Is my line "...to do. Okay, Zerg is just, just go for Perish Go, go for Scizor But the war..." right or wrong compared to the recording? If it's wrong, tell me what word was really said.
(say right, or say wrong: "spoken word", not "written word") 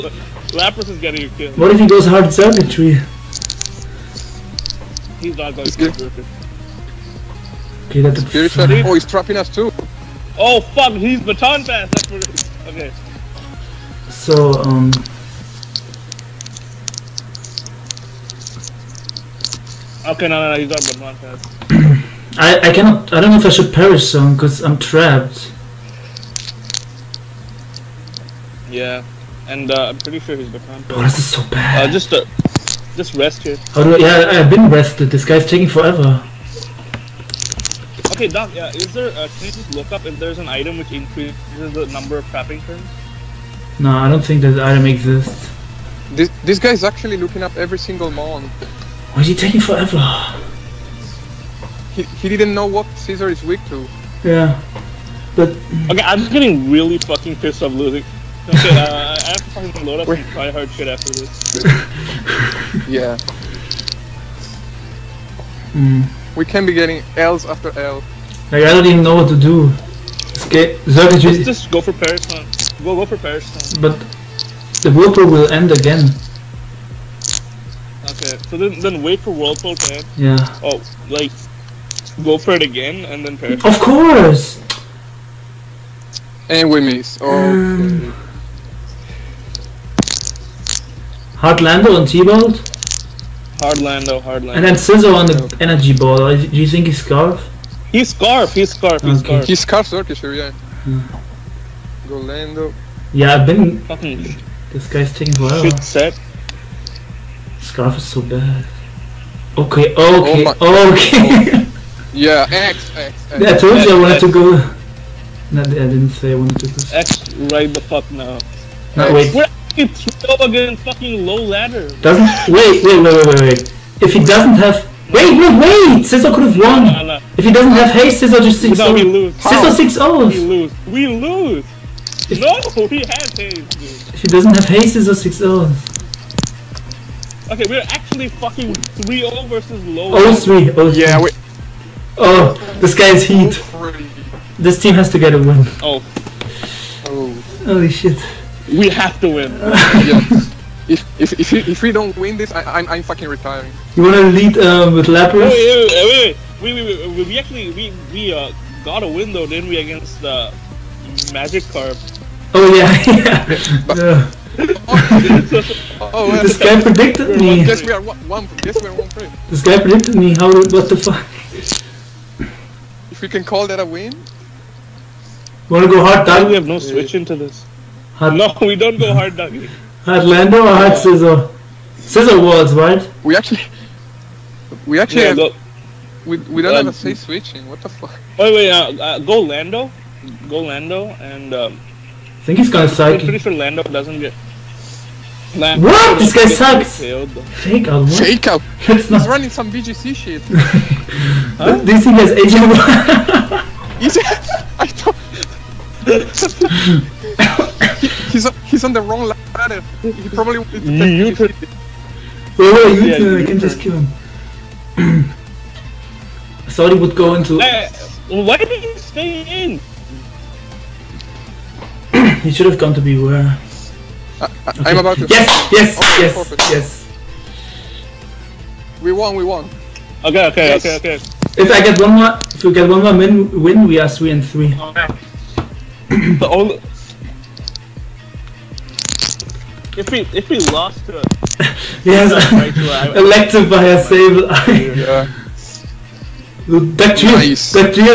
wrong: "Perish", not "Scizor".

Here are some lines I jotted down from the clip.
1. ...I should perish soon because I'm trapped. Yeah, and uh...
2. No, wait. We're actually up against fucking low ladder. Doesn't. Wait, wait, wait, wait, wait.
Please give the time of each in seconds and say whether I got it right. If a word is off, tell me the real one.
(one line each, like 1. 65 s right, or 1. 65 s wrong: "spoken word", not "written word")
1. 23 s right
2. 118 s right.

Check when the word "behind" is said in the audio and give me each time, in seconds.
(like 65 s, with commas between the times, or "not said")
30 s.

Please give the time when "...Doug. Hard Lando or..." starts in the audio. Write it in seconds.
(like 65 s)
179 s.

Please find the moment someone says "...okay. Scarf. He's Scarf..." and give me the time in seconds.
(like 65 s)
99 s.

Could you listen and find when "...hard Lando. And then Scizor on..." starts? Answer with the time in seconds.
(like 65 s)
94 s.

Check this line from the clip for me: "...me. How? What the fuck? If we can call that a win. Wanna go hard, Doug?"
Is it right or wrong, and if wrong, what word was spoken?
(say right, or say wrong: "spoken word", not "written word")
right.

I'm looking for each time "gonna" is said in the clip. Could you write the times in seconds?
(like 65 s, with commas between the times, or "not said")
192 s.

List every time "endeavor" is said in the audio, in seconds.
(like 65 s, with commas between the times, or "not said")
not said.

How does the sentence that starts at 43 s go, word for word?
No, I don't think that item exists.